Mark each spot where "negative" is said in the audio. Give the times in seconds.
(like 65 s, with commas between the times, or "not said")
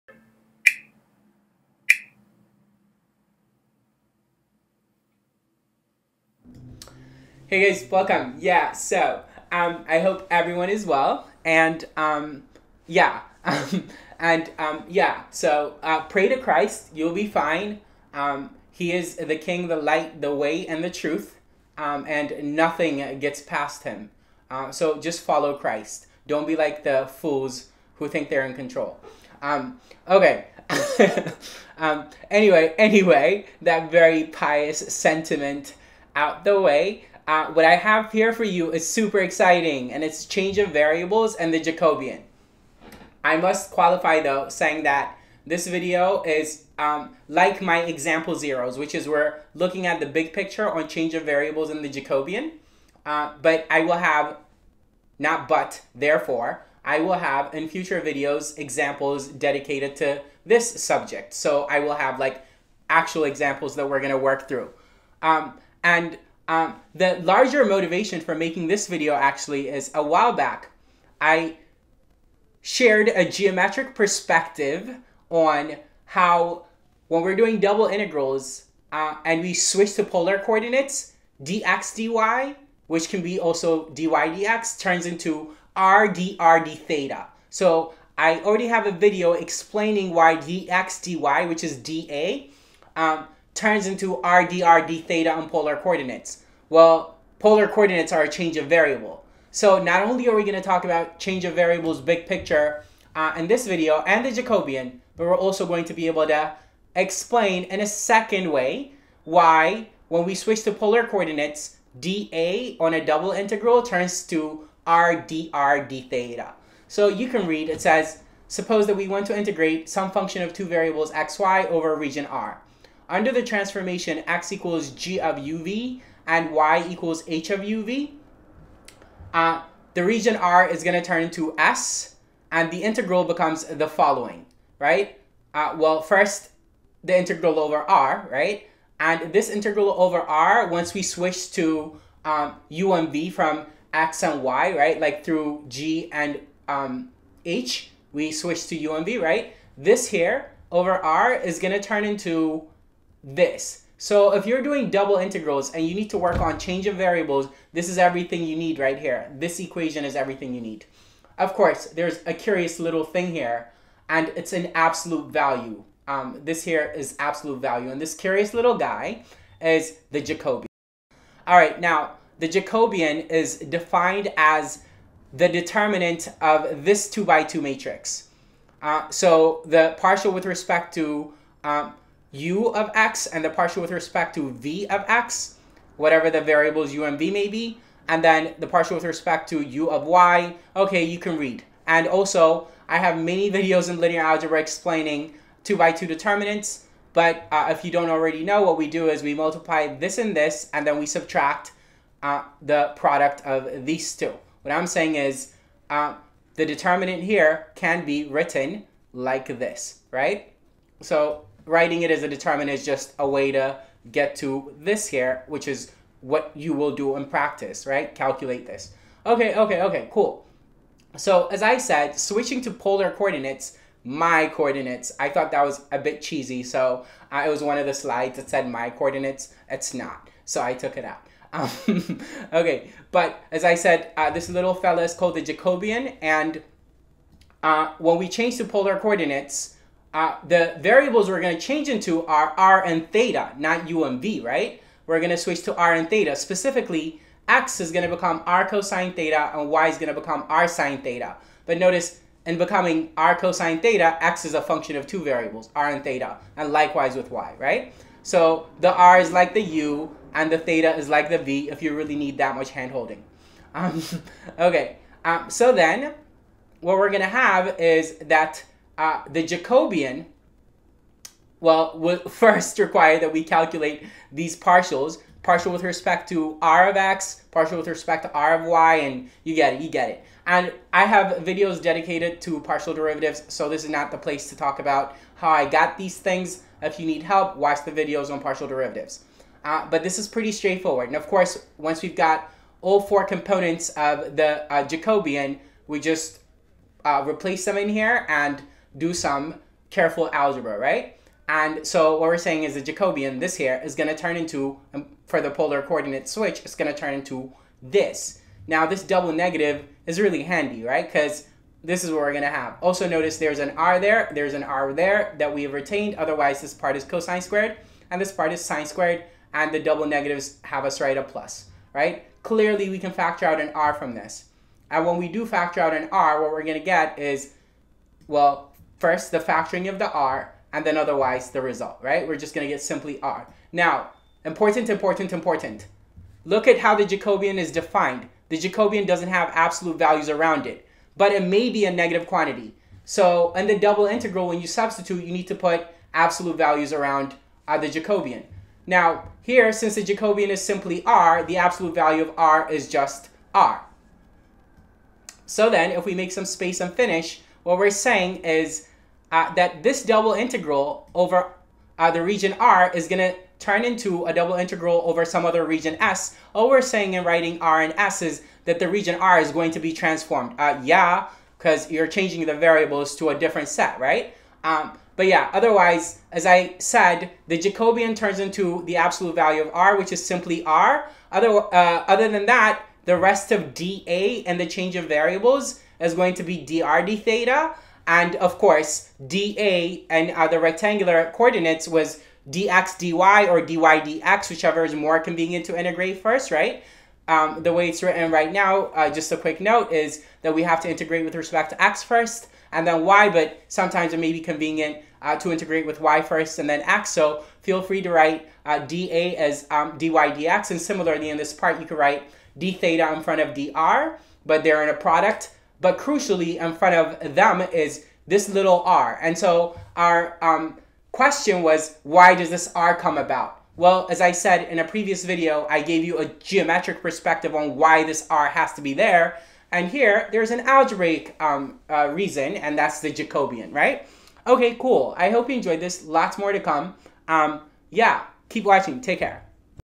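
309 s, 320 s, 341 s.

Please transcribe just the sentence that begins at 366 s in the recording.
All we're saying in writing R and S is that the region R is going to be transformed.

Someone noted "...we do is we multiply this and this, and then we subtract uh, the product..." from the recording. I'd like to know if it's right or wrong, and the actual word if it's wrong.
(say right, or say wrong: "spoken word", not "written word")
right.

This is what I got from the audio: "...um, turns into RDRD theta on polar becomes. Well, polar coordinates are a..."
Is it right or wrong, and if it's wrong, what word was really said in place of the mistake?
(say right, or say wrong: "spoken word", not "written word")
wrong: "coordinates", not "becomes".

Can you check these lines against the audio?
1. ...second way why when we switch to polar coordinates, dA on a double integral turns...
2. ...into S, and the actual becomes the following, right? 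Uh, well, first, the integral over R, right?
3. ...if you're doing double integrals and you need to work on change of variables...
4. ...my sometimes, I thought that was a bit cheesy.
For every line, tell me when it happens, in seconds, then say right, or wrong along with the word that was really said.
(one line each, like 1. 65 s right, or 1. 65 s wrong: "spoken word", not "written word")
1. 107 s right
2. 131 s wrong: "integral", not "actual"
3. 154 s right
4. 224 s wrong: "coordinates", not "sometimes".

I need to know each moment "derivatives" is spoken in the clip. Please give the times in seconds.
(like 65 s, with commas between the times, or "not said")
282 s, 288 s.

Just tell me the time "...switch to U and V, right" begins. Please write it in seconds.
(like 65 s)
148 s.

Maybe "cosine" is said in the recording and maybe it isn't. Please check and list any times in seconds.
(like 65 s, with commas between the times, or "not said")
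248 s, 253 s, 317 s.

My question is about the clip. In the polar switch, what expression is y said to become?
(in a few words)
r sine theta.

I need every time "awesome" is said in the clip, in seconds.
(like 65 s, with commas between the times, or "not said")
not said.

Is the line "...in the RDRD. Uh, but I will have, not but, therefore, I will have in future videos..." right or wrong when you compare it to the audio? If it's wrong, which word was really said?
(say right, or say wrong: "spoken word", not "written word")
wrong: "Jacobian", not "RDRD".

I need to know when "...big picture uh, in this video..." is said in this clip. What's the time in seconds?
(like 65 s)
101 s.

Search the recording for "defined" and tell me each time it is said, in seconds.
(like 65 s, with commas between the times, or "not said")
173 s, 337 s.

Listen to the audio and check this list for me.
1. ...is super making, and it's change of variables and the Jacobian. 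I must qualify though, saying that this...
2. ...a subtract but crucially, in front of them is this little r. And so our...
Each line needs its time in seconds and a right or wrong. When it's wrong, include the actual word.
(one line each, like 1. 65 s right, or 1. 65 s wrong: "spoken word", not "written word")
1. 38 s wrong: "exciting", not "making"
2. 414 s wrong: "product", not "subtract".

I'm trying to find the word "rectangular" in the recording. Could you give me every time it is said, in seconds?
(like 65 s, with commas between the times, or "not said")
390 s.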